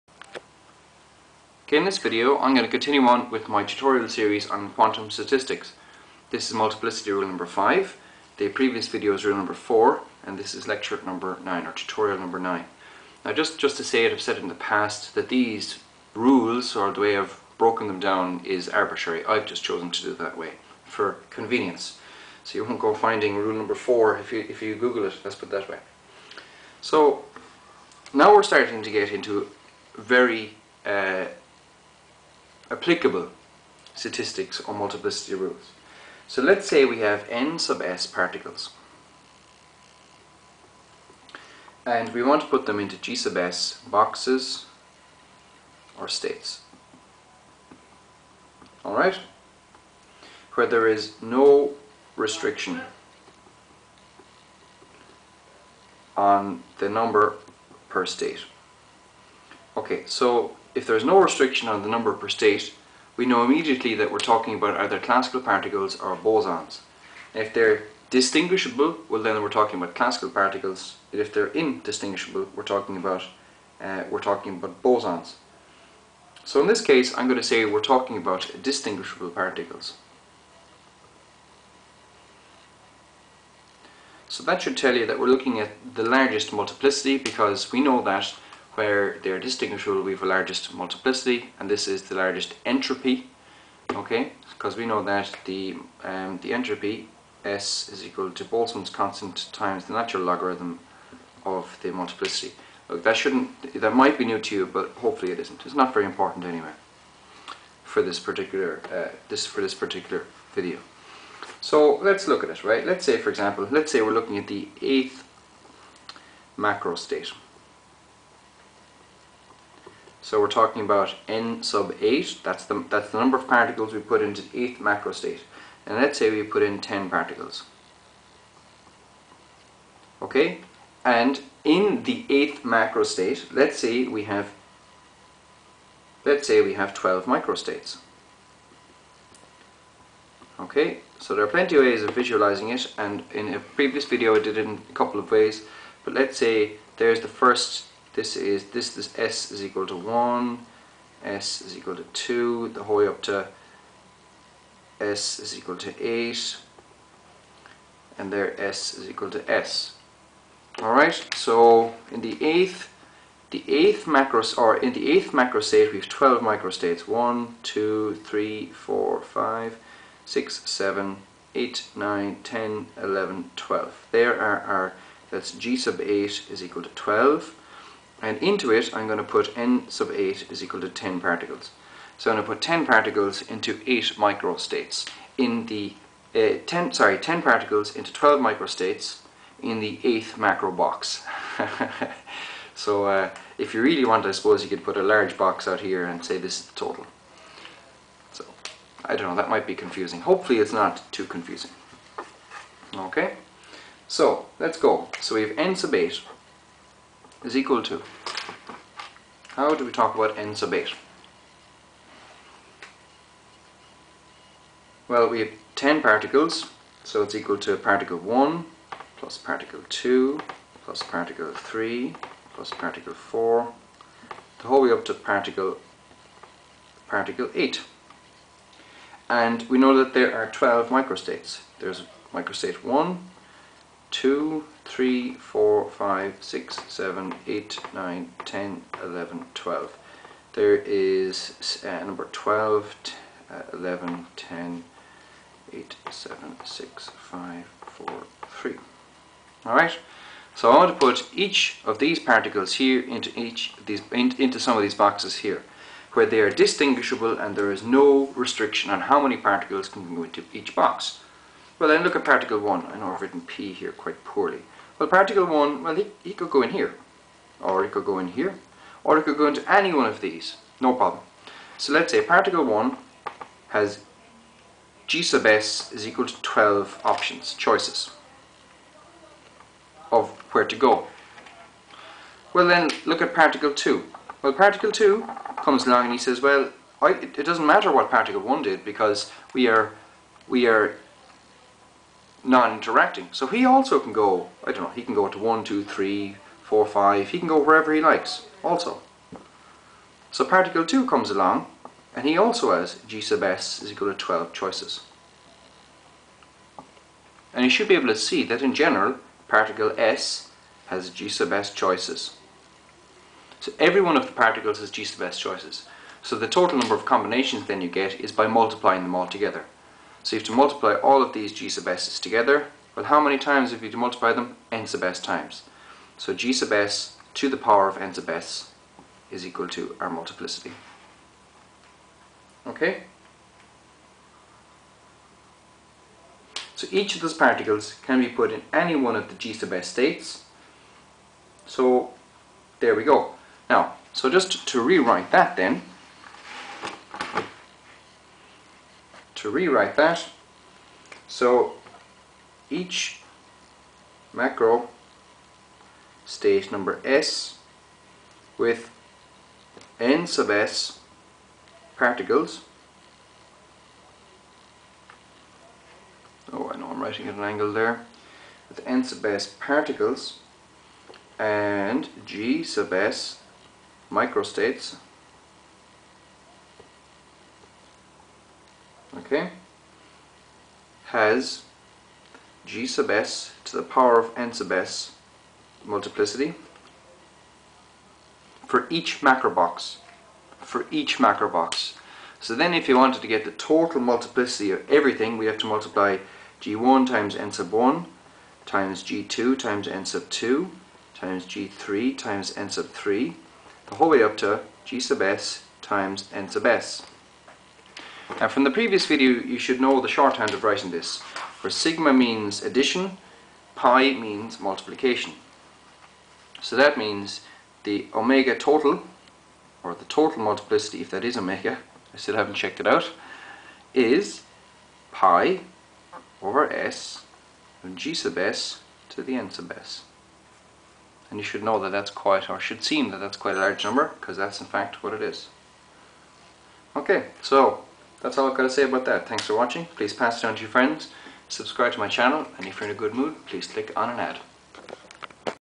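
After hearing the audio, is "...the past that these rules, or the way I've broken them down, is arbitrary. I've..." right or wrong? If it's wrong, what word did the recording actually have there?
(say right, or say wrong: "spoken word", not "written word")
right.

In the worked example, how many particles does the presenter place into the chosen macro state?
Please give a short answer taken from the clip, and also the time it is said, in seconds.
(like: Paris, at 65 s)
10, at 126 s.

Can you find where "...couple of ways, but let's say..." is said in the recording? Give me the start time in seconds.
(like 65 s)
144 s.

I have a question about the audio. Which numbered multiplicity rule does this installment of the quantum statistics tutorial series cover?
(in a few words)
5.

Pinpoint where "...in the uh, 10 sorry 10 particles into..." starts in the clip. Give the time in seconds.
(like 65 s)
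185 s.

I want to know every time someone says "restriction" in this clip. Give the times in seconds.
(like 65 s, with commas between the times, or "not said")
52 s, 61 s, 258 s.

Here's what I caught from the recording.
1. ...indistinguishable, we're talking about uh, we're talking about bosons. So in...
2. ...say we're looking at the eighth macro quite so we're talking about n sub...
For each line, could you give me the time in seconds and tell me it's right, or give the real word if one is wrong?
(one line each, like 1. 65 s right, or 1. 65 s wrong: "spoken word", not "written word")
1. 71 s right
2. 113 s wrong: "state", not "quite".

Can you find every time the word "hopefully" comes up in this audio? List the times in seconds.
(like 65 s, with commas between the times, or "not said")
104 s, 200 s.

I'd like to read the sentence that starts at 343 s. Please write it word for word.
Now, so just to rewrite that then, to rewrite that.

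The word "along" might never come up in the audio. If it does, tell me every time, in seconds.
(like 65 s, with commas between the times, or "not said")
285 s, 301 s.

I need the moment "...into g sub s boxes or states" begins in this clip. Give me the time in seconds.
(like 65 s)
42 s.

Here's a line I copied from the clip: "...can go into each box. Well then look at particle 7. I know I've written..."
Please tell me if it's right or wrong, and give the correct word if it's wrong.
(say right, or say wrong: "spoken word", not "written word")
wrong: "1", not "7".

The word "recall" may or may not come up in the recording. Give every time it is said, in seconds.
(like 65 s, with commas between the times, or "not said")
not said.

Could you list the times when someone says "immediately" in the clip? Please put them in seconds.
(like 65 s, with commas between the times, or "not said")
63 s.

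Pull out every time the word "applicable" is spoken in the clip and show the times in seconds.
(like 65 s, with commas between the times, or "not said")
32 s.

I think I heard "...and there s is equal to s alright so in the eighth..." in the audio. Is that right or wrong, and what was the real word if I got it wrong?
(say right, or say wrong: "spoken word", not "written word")
right.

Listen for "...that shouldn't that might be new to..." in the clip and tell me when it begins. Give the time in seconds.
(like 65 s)
103 s.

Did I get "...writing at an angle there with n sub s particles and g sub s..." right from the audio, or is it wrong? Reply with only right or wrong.
right.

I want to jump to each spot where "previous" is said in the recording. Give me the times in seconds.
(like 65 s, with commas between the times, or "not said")
8 s, 143 s, 408 s.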